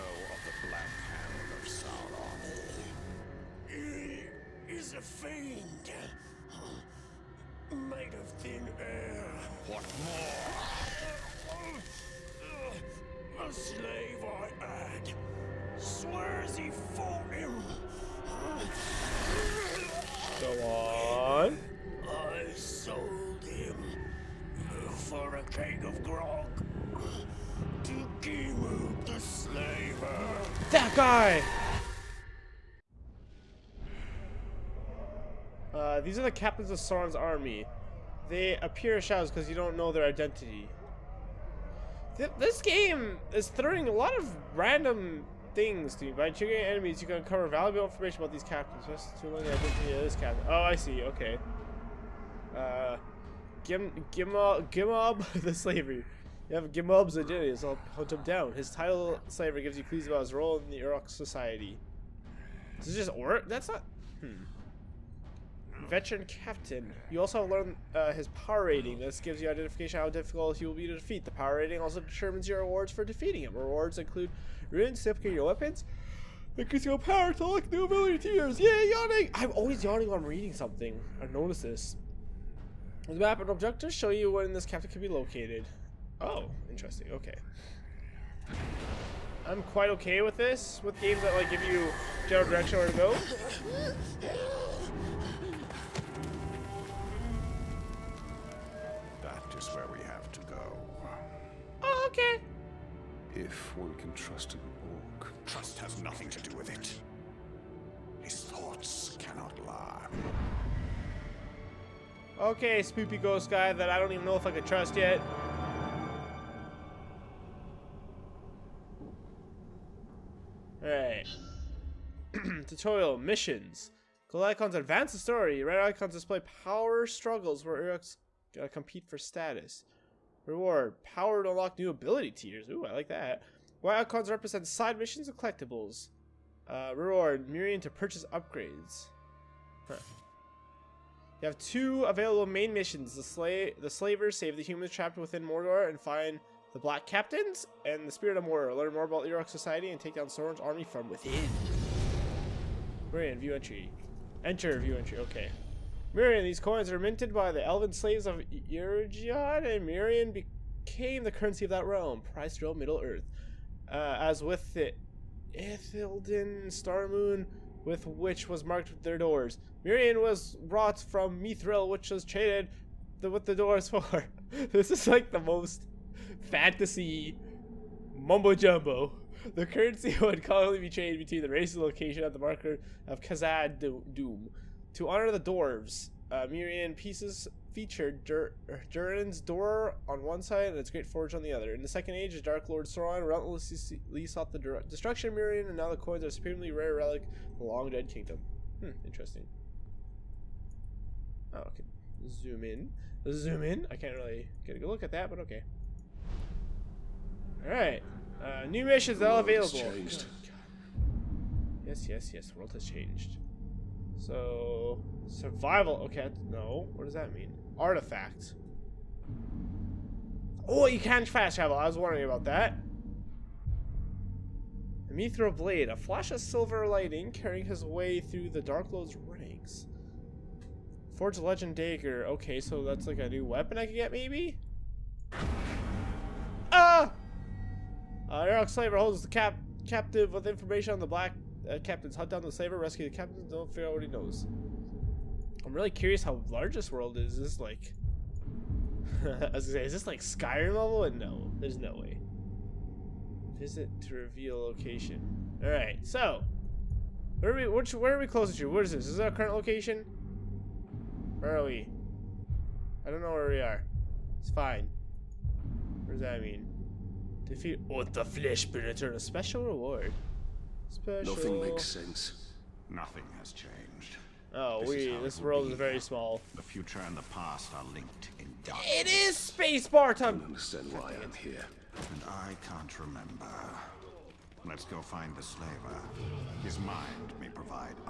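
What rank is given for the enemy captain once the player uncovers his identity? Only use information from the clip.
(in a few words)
Veteran Captain.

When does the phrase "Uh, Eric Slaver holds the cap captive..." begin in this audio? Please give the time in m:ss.
3:58.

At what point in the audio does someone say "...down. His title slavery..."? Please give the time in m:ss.
0:58.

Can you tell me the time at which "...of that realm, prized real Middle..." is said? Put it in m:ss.
2:41.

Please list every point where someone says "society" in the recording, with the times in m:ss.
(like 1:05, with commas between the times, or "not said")
1:01, 2:29.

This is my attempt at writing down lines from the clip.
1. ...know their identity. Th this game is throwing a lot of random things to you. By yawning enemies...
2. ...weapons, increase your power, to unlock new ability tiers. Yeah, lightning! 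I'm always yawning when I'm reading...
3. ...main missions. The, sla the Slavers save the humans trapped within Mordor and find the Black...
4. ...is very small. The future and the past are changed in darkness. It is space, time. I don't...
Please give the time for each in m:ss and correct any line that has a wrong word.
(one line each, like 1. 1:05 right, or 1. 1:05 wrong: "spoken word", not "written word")
1. 0:39 wrong: "triggering", not "yawning"
2. 1:15 wrong: "yawning", not "lightning"
3. 2:22 right
4. 4:35 wrong: "linked", not "changed".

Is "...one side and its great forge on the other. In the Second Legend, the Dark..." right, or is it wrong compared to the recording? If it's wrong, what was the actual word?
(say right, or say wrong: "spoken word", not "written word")
wrong: "Age", not "Legend".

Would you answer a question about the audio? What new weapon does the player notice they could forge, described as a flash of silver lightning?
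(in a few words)
Legend Dagger.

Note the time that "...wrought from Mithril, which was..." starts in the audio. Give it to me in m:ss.
2:50.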